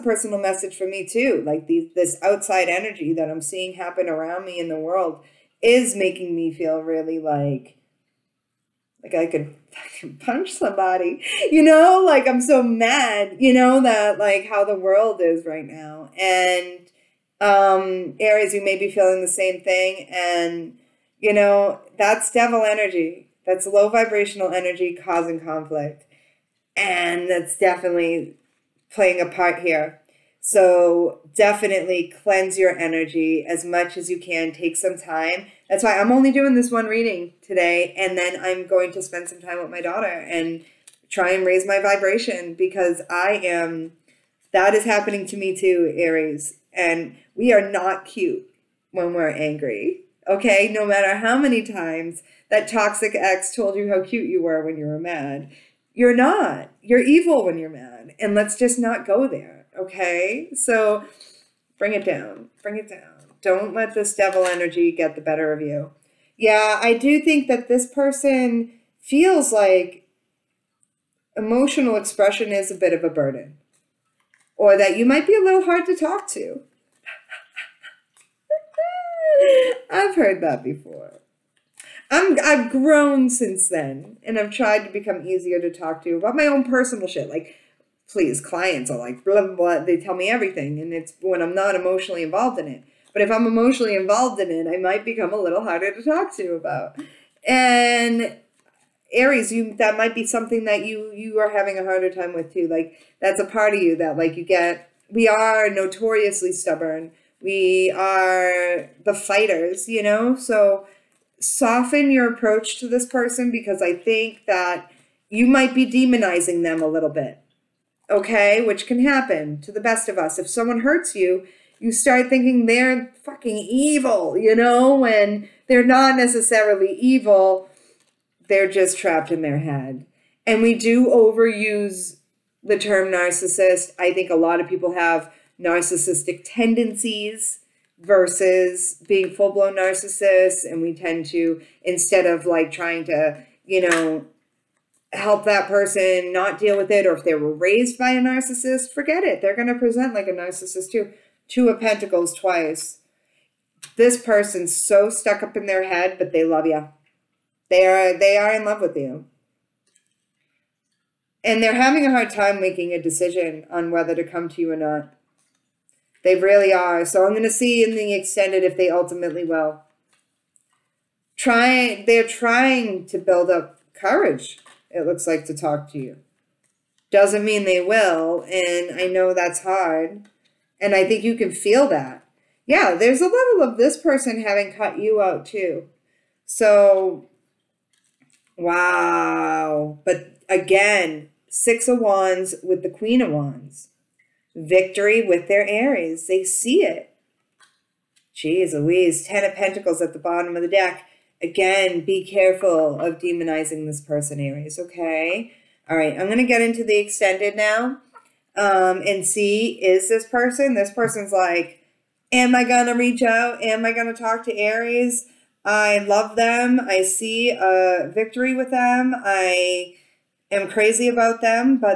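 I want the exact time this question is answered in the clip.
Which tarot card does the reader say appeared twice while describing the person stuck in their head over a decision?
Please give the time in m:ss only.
2:31.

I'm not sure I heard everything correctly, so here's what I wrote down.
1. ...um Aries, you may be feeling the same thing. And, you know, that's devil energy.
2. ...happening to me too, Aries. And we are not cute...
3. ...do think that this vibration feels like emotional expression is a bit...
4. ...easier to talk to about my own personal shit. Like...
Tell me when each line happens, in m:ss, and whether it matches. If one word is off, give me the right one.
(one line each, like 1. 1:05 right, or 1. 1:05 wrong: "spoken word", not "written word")
1. 0:17 right
2. 0:44 right
3. 1:06 wrong: "person", not "vibration"
4. 1:25 right.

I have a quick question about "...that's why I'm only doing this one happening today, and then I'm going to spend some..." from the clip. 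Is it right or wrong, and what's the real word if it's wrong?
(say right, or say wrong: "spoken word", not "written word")
wrong: "reading", not "happening".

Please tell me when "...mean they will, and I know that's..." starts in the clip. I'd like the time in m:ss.
2:57.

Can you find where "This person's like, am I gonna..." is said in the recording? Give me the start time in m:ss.
3:30.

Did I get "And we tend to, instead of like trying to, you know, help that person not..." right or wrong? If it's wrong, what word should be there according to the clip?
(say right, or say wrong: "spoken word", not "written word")
right.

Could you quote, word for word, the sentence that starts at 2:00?
If someone hurts you, you start thinking they're fucking evil, you know, when they're not necessarily evil.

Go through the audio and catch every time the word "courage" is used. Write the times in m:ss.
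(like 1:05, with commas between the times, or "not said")
2:53.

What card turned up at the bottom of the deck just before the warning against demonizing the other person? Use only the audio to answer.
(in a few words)
Ten of Pentacles.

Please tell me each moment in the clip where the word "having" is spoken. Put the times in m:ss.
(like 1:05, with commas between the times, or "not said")
1:41, 2:41, 3:04.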